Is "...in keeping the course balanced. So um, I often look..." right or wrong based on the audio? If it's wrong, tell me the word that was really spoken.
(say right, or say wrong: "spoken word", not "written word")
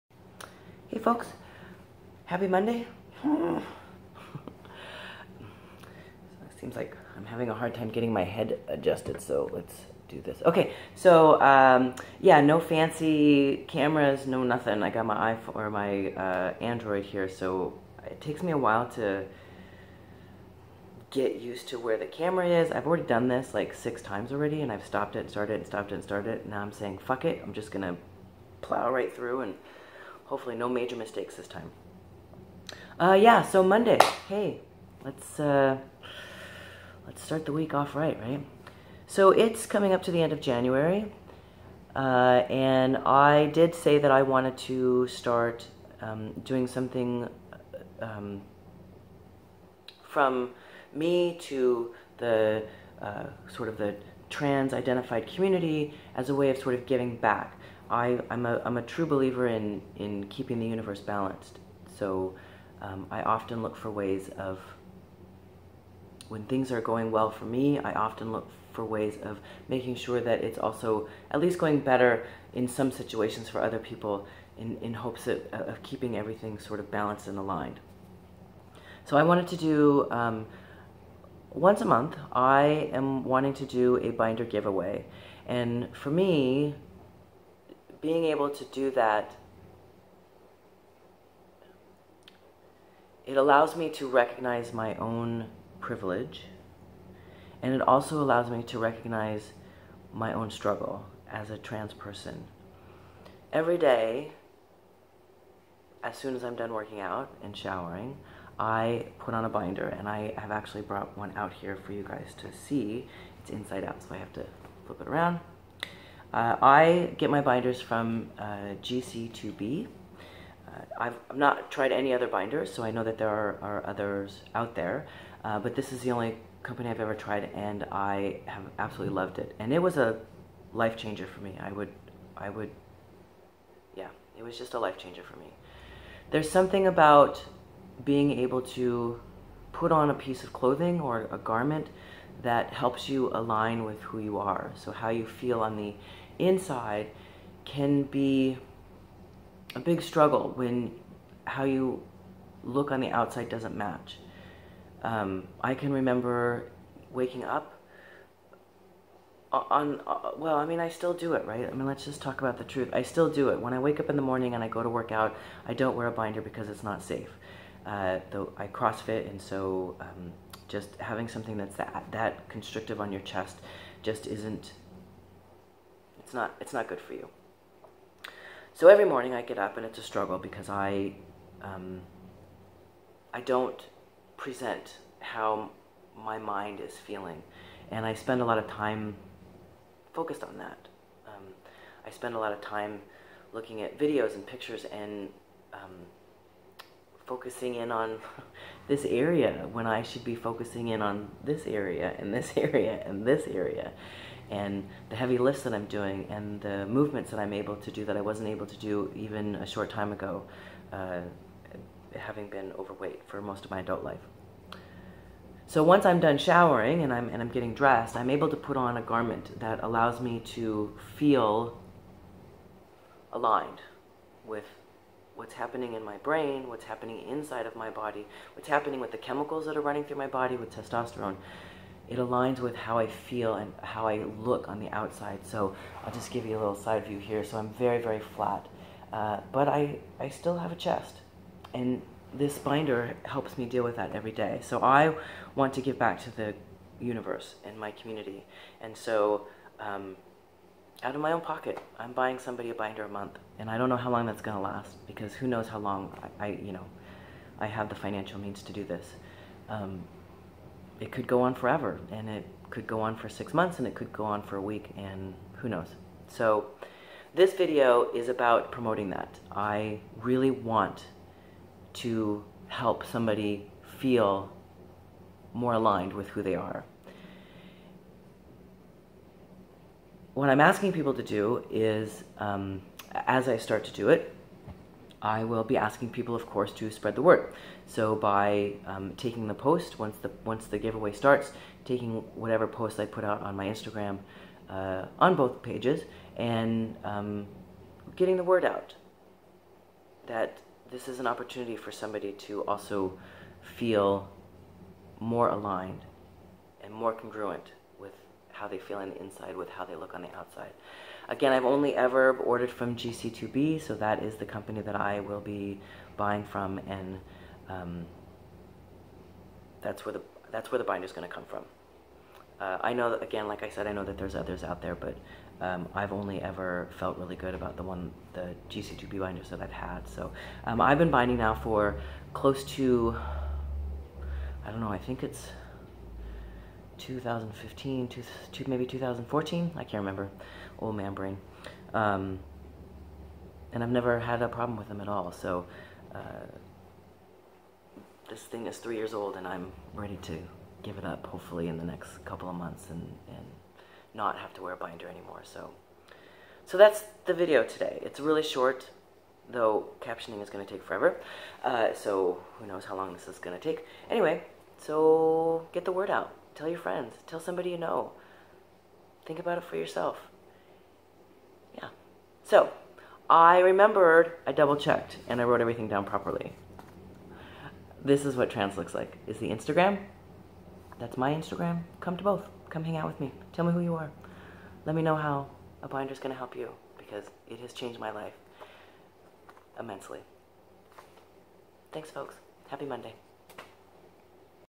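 wrong: "universe", not "course".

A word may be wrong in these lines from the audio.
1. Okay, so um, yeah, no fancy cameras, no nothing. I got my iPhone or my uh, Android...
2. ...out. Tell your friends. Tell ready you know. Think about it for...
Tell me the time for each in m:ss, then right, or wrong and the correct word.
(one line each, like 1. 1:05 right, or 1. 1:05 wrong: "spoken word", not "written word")
1. 0:10 right
2. 6:06 wrong: "somebody", not "ready".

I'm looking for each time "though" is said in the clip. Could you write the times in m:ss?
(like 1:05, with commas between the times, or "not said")
2:48, 5:59.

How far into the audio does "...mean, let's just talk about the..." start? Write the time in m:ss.
2:41.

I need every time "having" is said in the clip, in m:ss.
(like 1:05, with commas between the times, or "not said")
0:07, 2:50, 3:32.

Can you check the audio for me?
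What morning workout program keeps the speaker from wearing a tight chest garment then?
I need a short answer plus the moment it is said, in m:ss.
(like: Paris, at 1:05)
CrossFit, at 2:48.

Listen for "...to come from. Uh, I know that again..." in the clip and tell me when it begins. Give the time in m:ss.
5:21.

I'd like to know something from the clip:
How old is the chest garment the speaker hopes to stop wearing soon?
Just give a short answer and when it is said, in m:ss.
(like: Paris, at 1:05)
3 years, at 5:48.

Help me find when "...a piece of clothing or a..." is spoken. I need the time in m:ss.
2:20.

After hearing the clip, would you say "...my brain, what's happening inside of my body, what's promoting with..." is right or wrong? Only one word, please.
wrong.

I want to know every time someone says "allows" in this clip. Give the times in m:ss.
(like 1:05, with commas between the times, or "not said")
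1:33, 1:38, 3:39.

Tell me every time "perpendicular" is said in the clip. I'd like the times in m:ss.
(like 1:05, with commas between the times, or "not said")
not said.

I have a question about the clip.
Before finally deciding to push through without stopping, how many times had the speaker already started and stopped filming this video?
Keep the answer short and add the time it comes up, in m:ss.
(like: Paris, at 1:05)
6, at 0:23.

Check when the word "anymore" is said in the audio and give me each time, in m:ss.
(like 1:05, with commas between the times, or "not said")
5:55.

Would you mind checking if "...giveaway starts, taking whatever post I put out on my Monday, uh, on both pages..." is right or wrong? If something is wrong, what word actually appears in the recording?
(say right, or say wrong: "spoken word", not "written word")
wrong: "Instagram", not "Monday".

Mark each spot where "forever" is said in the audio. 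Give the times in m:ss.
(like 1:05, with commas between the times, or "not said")
4:21, 6:00.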